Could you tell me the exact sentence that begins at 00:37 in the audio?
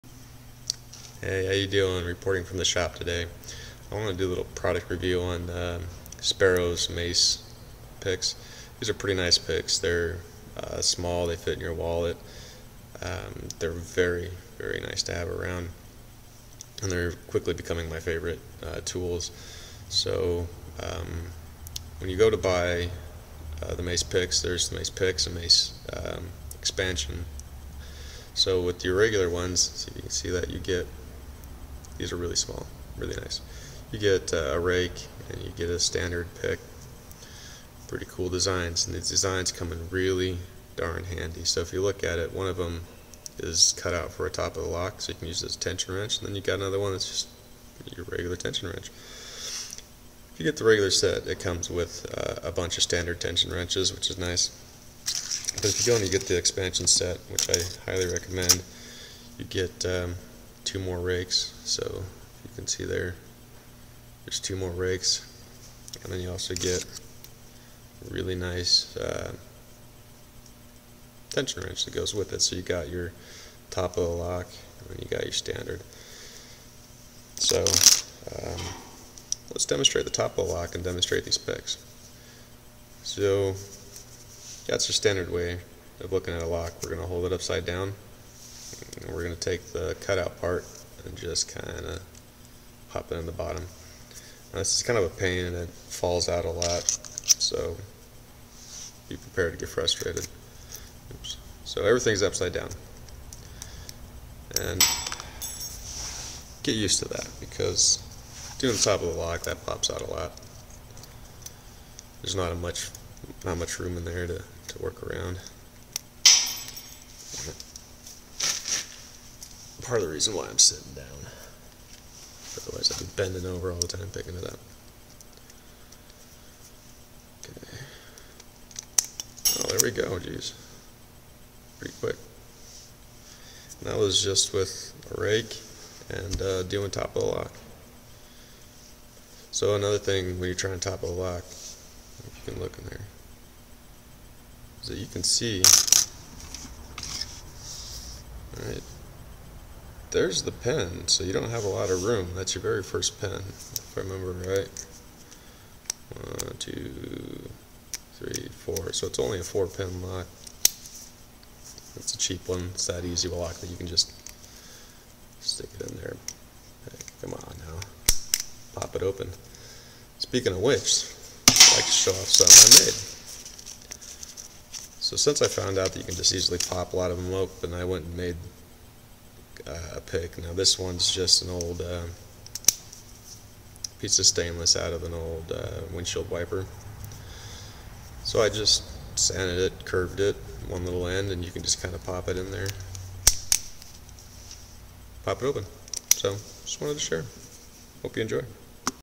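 Pretty cool designs, and these designs come in really darn handy.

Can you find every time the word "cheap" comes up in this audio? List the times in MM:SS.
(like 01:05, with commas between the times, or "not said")
02:42.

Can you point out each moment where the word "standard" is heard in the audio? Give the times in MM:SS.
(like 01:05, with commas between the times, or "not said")
00:35, 00:52, 01:15, 01:24.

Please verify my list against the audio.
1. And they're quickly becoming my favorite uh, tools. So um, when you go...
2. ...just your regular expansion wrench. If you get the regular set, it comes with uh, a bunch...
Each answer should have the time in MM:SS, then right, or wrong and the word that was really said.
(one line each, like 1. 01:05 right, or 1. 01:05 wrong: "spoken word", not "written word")
1. 00:16 right
2. 00:47 wrong: "tension", not "expansion".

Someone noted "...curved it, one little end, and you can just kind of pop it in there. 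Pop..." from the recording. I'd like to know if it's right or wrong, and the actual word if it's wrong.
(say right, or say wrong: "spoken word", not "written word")
right.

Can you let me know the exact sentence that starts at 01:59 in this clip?
part of the reason why I'm sitting down.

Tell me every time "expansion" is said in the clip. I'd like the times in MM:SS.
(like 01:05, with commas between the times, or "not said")
00:26, 00:56.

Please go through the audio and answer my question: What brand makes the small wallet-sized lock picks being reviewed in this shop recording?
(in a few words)
Sparrow's.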